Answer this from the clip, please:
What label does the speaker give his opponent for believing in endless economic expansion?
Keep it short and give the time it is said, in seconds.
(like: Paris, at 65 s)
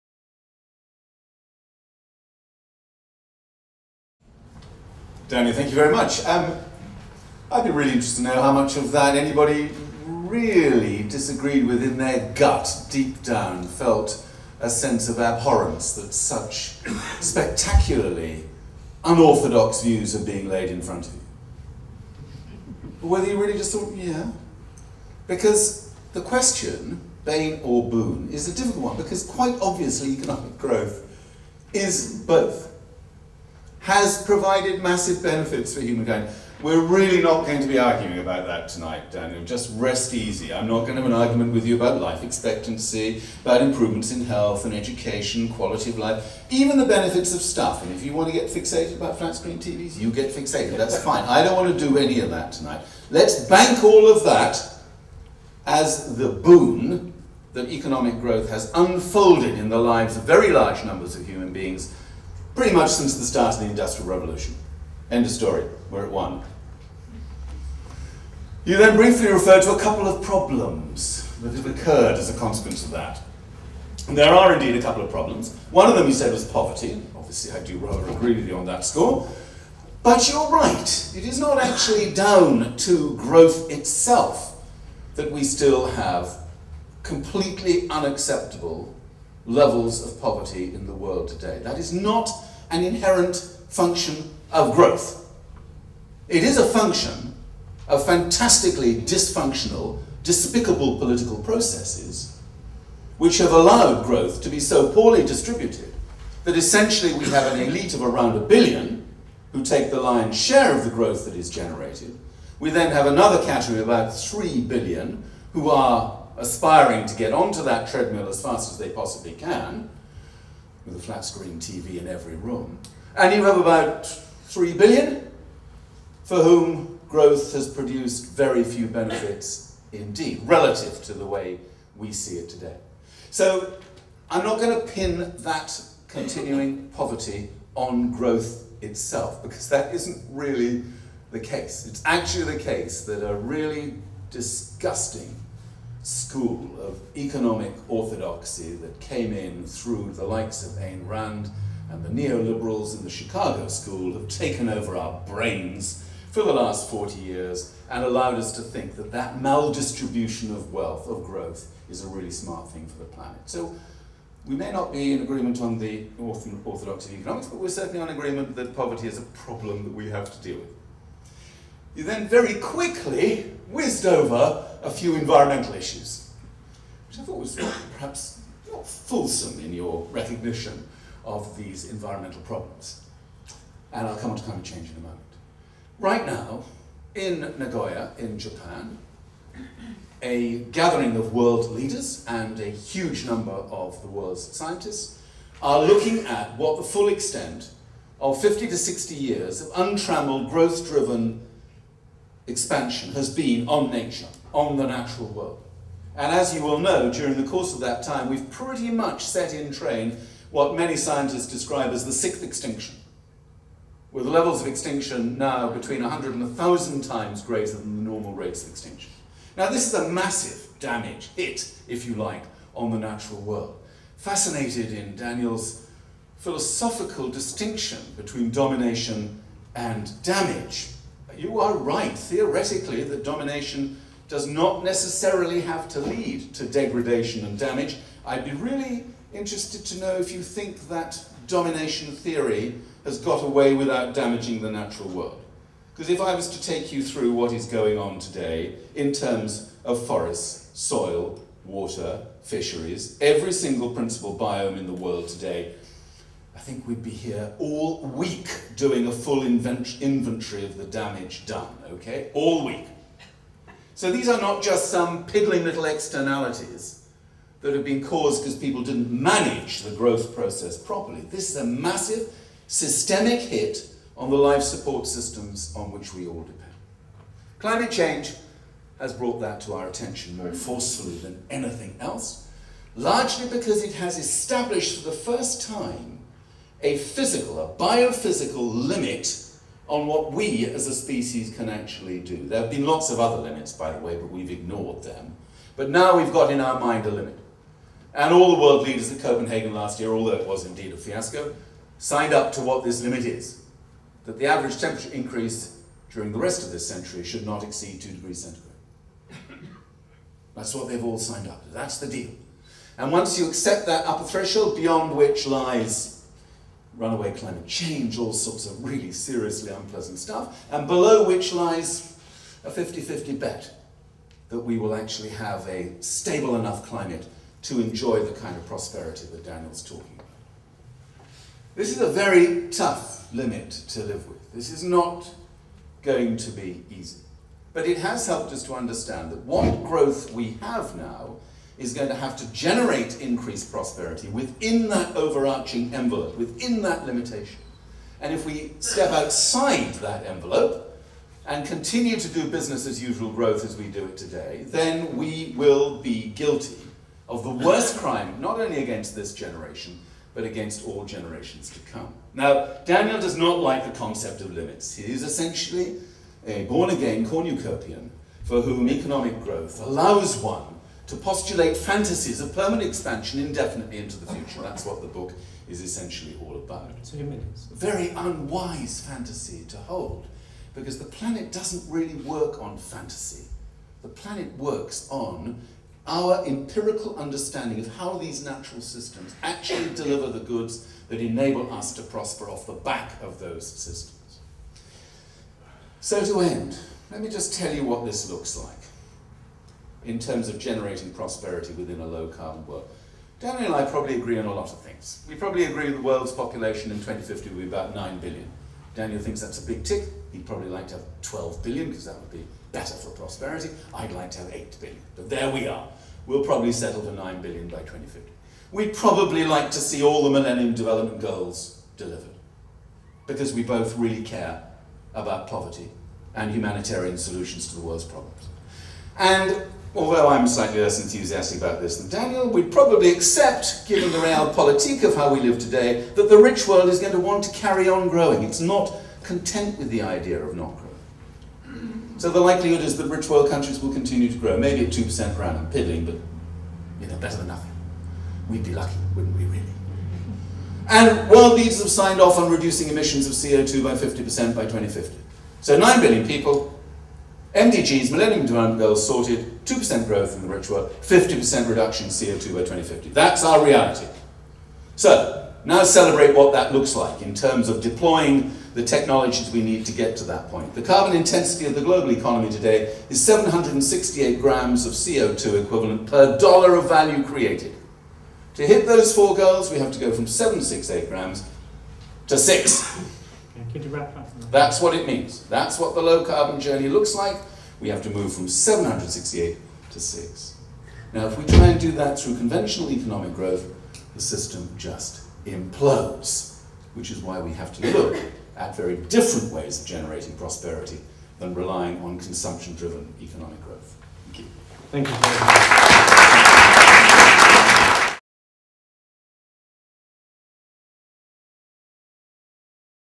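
born again cornucopian, at 366 s.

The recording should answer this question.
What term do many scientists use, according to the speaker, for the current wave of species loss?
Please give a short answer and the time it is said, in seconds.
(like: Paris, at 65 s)
the sixth extinction, at 212 s.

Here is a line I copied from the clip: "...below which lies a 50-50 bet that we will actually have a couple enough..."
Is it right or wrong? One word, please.
wrong.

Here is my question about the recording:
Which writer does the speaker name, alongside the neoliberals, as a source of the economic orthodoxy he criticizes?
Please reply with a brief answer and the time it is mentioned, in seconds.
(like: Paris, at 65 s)
Ayn Rand, at 150 s.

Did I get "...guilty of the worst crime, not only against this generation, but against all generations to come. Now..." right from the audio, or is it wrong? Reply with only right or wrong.
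right.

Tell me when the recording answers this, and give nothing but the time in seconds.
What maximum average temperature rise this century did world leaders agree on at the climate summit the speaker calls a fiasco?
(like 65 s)
308 s.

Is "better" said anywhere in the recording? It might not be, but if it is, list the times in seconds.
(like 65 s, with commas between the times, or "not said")
412 s, 447 s.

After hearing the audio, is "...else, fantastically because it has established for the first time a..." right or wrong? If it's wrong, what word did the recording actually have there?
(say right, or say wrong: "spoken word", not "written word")
wrong: "largely", not "fantastically".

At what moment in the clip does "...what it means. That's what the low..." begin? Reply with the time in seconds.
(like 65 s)
484 s.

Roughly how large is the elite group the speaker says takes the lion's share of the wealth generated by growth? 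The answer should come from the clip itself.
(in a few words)
1 billion.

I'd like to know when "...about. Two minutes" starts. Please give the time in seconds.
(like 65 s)
376 s.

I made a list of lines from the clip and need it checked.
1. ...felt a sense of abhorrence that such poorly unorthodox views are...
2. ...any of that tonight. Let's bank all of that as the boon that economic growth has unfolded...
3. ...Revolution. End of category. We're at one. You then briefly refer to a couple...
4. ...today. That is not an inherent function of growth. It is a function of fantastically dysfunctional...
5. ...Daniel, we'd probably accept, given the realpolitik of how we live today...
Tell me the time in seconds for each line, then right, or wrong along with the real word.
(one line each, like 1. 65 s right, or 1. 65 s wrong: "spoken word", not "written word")
1. 13 s wrong: "spectacularly", not "poorly"
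2. 51 s right
3. 64 s wrong: "story", not "category"
4. 91 s right
5. 432 s right.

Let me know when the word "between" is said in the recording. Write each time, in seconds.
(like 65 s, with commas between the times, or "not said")
215 s, 228 s.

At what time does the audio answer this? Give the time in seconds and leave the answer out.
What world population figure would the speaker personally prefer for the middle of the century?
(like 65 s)
414 s.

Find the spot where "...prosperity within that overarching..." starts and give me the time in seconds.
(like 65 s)
343 s.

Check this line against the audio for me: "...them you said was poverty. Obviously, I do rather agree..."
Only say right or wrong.
right.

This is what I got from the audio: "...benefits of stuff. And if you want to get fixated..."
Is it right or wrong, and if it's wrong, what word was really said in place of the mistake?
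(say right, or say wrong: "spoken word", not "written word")
right.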